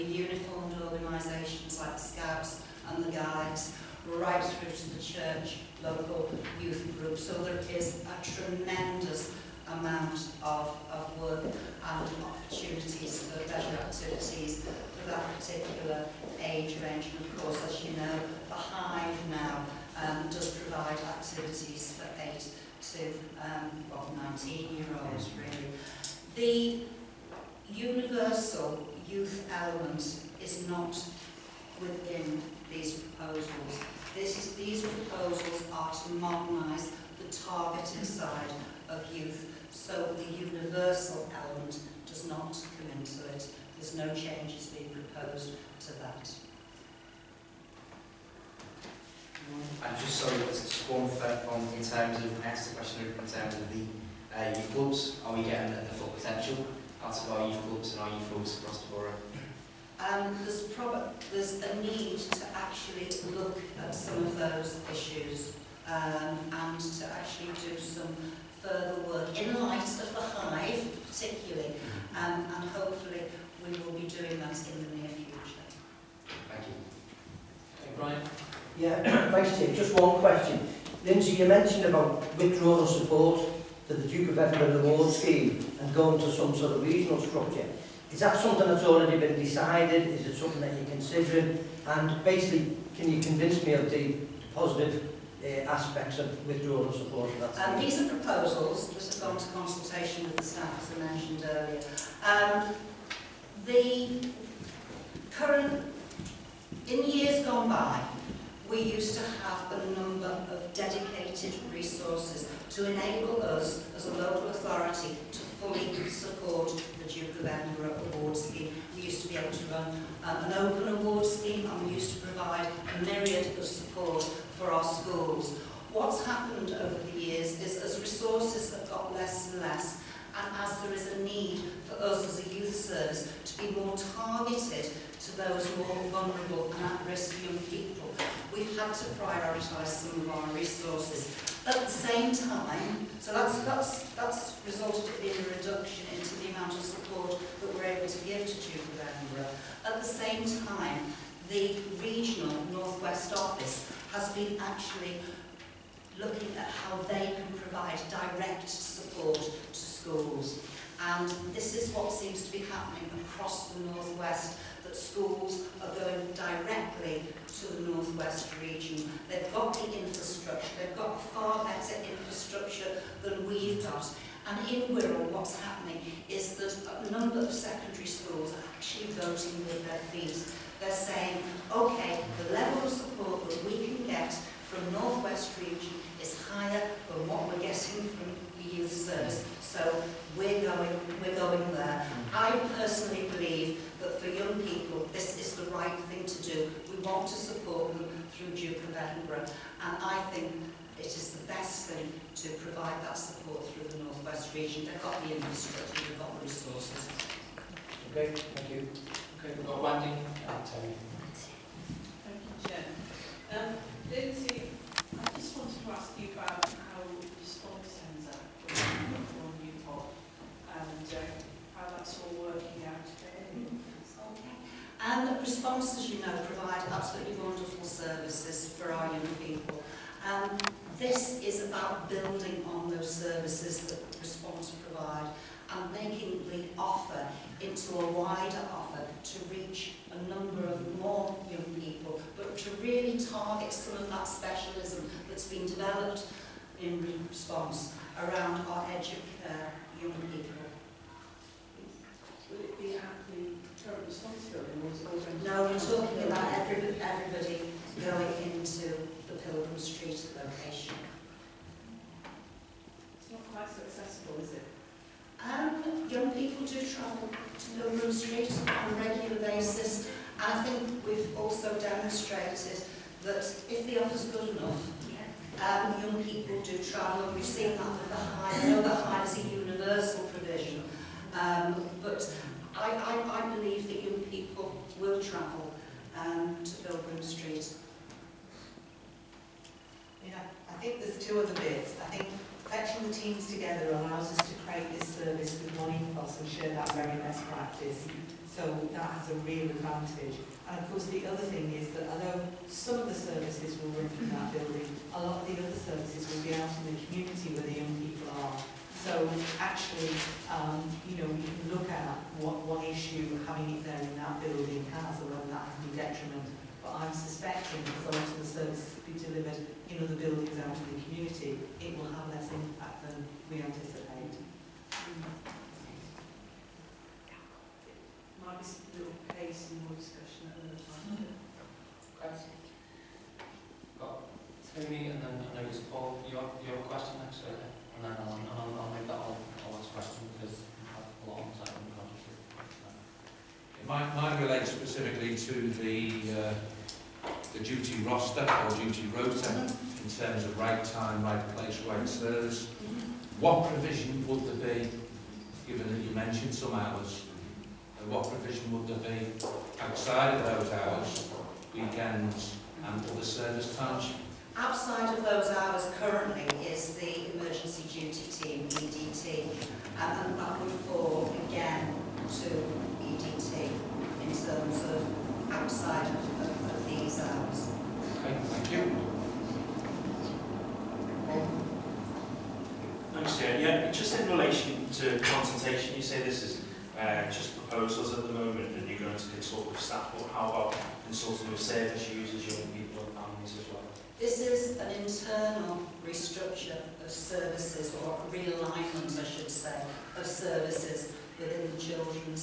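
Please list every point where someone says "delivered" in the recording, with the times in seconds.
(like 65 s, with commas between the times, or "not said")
319 s.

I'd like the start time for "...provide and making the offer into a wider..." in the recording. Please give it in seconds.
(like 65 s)
234 s.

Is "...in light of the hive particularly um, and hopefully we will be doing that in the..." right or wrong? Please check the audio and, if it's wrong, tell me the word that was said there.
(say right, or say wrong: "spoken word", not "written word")
right.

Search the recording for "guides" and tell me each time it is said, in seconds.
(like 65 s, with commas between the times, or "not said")
3 s.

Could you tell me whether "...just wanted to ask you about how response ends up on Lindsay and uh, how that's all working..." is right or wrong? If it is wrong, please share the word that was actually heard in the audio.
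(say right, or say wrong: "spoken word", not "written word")
wrong: "Newport", not "Lindsay".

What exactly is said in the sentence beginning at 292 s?
I think fetching the teams together allows us to create this service with one ethos and share that very best practice.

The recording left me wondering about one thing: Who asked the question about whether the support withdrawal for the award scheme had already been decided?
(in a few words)
Brian.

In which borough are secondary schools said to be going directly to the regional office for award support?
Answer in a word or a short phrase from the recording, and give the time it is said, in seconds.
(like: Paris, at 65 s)
Wirral, at 174 s.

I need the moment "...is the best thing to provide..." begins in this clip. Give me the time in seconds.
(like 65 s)
201 s.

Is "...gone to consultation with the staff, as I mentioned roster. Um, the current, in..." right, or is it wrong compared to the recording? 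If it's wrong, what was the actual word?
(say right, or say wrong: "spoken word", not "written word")
wrong: "earlier", not "roster".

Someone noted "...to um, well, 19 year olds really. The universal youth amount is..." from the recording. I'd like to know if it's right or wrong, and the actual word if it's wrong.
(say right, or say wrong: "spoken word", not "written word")
wrong: "element", not "amount".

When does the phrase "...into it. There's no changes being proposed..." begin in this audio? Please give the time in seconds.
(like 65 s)
42 s.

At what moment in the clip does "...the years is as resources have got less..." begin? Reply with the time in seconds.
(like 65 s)
127 s.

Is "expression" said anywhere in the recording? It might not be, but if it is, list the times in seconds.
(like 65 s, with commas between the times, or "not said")
339 s.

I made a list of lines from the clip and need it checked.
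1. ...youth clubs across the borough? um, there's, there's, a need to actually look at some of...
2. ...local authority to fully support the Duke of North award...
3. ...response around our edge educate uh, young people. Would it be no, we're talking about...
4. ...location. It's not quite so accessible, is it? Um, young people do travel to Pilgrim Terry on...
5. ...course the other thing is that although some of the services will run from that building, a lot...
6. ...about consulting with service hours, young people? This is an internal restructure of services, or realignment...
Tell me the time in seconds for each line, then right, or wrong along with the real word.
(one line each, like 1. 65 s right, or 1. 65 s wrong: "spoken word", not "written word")
1. 58 s right
2. 114 s wrong: "Edinburgh", not "North"
3. 247 s right
4. 260 s wrong: "Street", not "Terry"
5. 300 s right
6. 390 s wrong: "users", not "hours".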